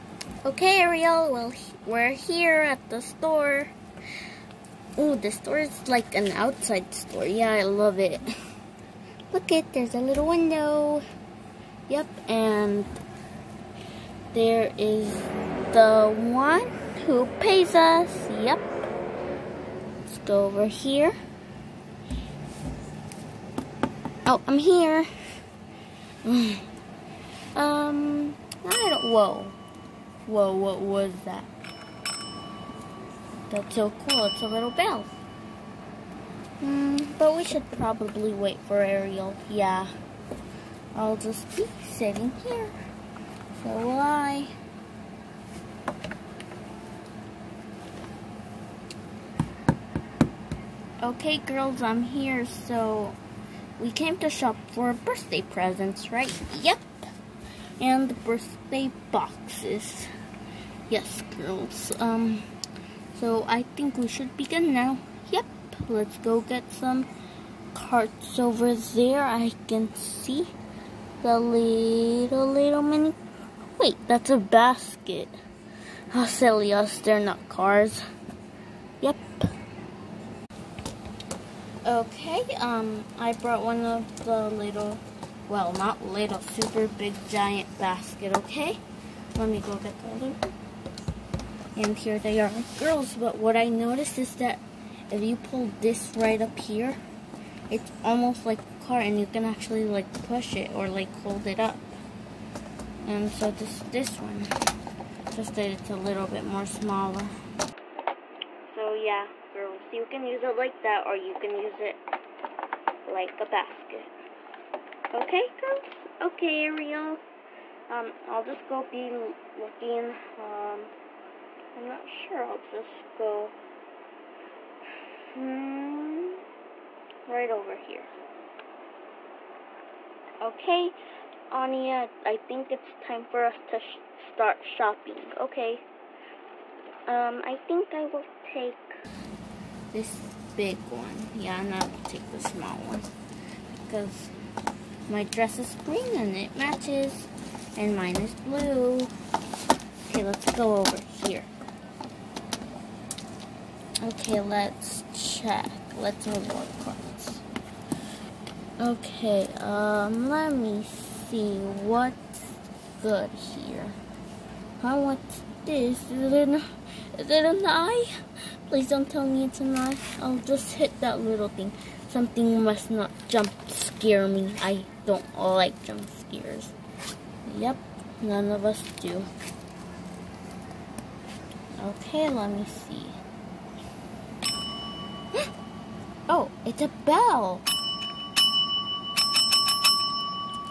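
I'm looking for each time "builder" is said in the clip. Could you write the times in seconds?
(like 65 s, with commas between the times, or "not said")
not said.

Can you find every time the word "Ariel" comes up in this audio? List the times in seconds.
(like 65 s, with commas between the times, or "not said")
38 s, 116 s.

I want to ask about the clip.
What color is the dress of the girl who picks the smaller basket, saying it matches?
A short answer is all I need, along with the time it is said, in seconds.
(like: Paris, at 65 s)
Green, at 145 s.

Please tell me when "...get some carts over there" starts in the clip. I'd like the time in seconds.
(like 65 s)
66 s.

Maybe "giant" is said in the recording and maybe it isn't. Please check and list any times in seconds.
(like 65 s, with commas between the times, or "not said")
87 s.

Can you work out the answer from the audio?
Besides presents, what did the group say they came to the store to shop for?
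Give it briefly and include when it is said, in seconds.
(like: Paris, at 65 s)
Birthday boxes, at 58 s.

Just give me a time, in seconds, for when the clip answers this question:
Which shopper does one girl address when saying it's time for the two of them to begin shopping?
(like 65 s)
131 s.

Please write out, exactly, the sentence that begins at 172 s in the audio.
Something must not jump scare me.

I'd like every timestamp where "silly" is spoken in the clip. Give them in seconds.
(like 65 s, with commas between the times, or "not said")
76 s.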